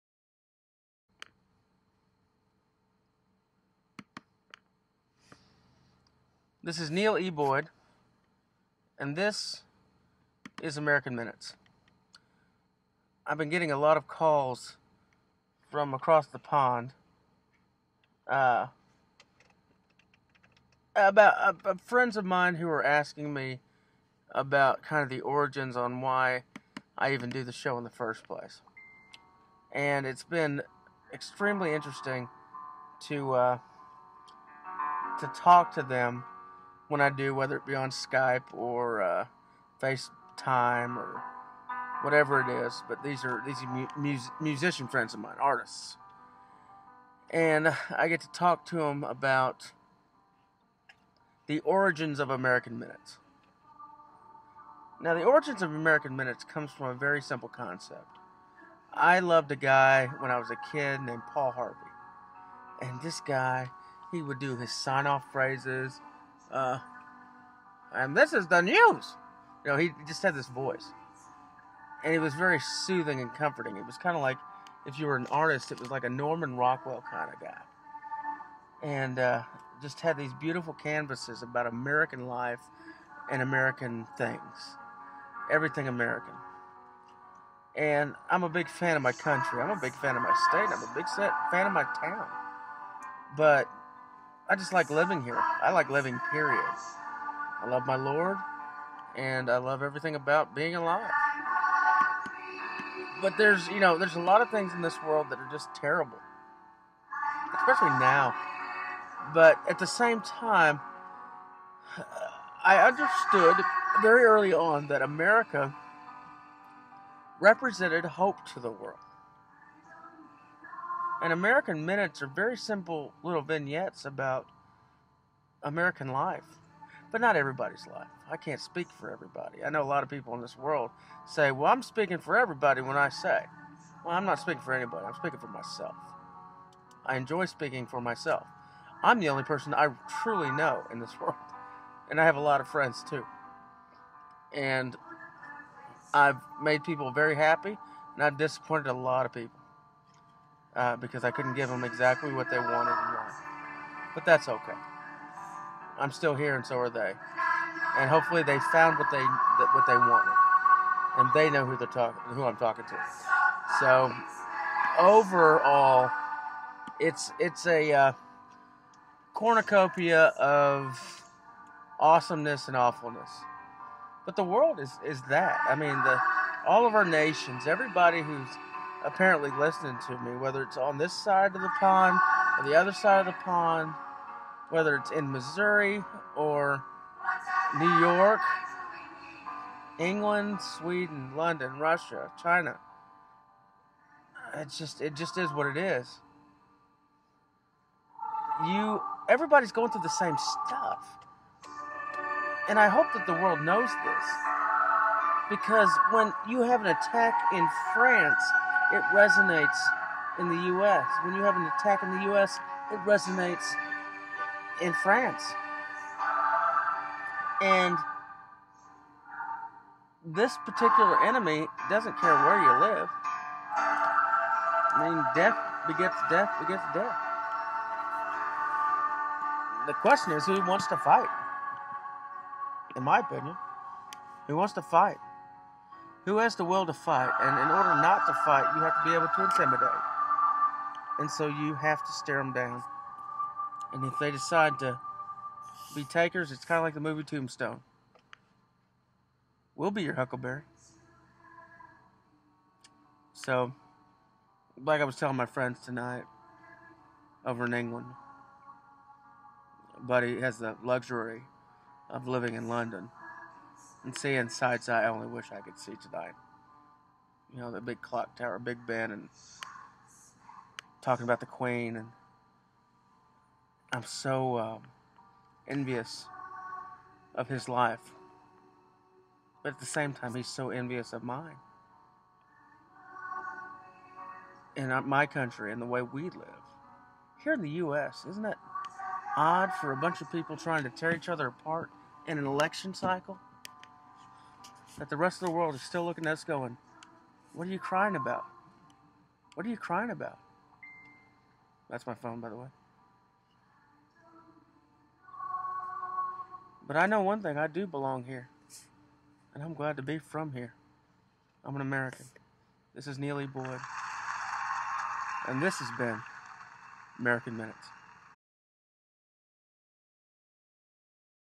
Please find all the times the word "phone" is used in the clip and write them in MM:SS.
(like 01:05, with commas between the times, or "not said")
05:02.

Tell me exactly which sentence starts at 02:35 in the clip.
I'm still here, and so are they.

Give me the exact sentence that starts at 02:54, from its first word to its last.
But the world is is that.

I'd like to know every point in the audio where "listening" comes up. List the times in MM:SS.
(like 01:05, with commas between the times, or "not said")
02:59.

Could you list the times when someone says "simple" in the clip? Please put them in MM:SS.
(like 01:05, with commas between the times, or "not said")
00:57, 02:02.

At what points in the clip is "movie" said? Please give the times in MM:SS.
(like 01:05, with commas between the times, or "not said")
04:06.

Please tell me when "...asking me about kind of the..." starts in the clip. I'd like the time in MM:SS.
00:22.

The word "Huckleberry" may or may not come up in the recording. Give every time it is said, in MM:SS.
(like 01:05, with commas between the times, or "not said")
04:10.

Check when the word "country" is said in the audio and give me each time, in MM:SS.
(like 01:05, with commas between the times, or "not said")
01:29, 04:45.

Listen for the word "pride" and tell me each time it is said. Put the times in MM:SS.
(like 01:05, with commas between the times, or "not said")
not said.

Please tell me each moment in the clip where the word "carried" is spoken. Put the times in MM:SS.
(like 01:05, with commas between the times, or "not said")
not said.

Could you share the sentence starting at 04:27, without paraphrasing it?
You know, the big clock tower, Big Ben, and talking about the Queen, and I'm so um, envious of his life.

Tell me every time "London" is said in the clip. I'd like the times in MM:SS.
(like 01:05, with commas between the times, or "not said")
03:11, 04:22.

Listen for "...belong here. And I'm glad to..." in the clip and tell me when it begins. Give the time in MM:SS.
05:07.